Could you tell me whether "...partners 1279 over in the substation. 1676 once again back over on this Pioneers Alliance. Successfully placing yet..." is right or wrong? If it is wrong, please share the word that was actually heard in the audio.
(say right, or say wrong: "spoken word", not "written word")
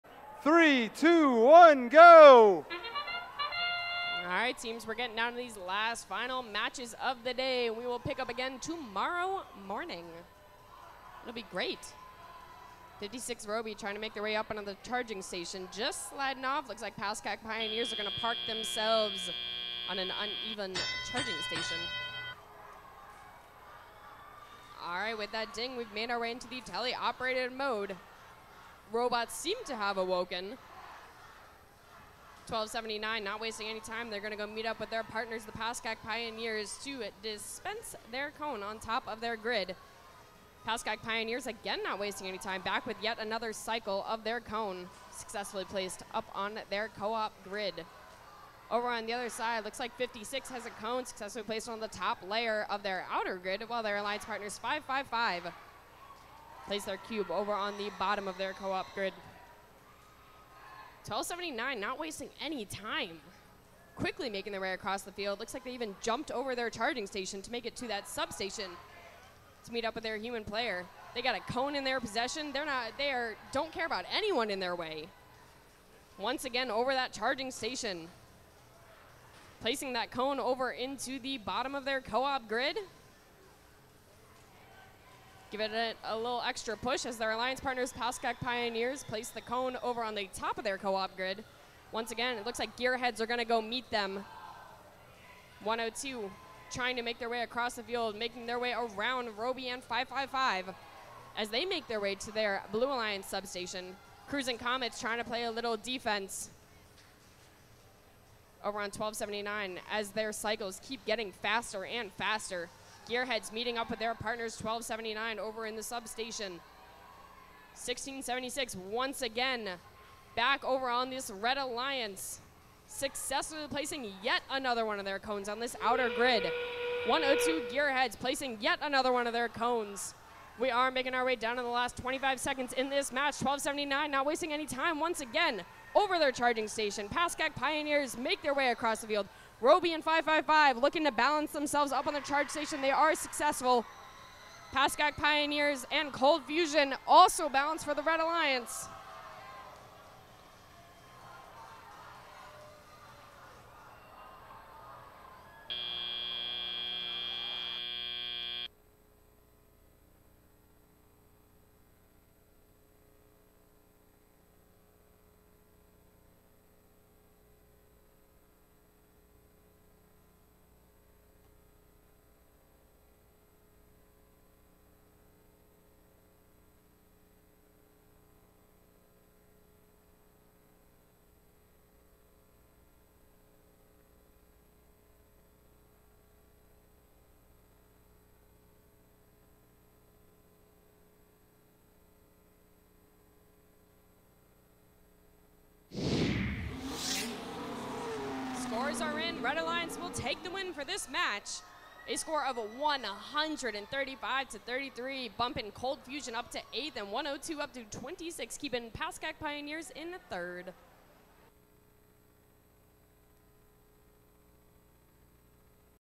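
wrong: "Red", not "Pioneers".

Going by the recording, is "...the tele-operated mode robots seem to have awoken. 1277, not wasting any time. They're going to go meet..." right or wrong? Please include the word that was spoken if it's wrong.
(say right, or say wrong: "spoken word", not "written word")
wrong: "1279", not "1277".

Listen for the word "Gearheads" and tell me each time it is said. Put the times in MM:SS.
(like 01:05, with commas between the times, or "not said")
01:32, 01:53, 02:07.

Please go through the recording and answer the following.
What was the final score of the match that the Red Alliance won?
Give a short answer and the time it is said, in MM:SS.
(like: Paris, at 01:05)
135 to 33, at 03:22.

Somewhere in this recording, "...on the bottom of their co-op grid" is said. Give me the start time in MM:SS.
00:57.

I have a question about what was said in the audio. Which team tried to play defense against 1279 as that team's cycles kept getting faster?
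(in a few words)
Cruising Comets.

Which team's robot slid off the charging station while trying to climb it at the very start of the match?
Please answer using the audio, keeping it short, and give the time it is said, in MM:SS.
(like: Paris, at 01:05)
56 Roby, at 00:13.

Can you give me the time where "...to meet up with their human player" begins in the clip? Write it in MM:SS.
01:09.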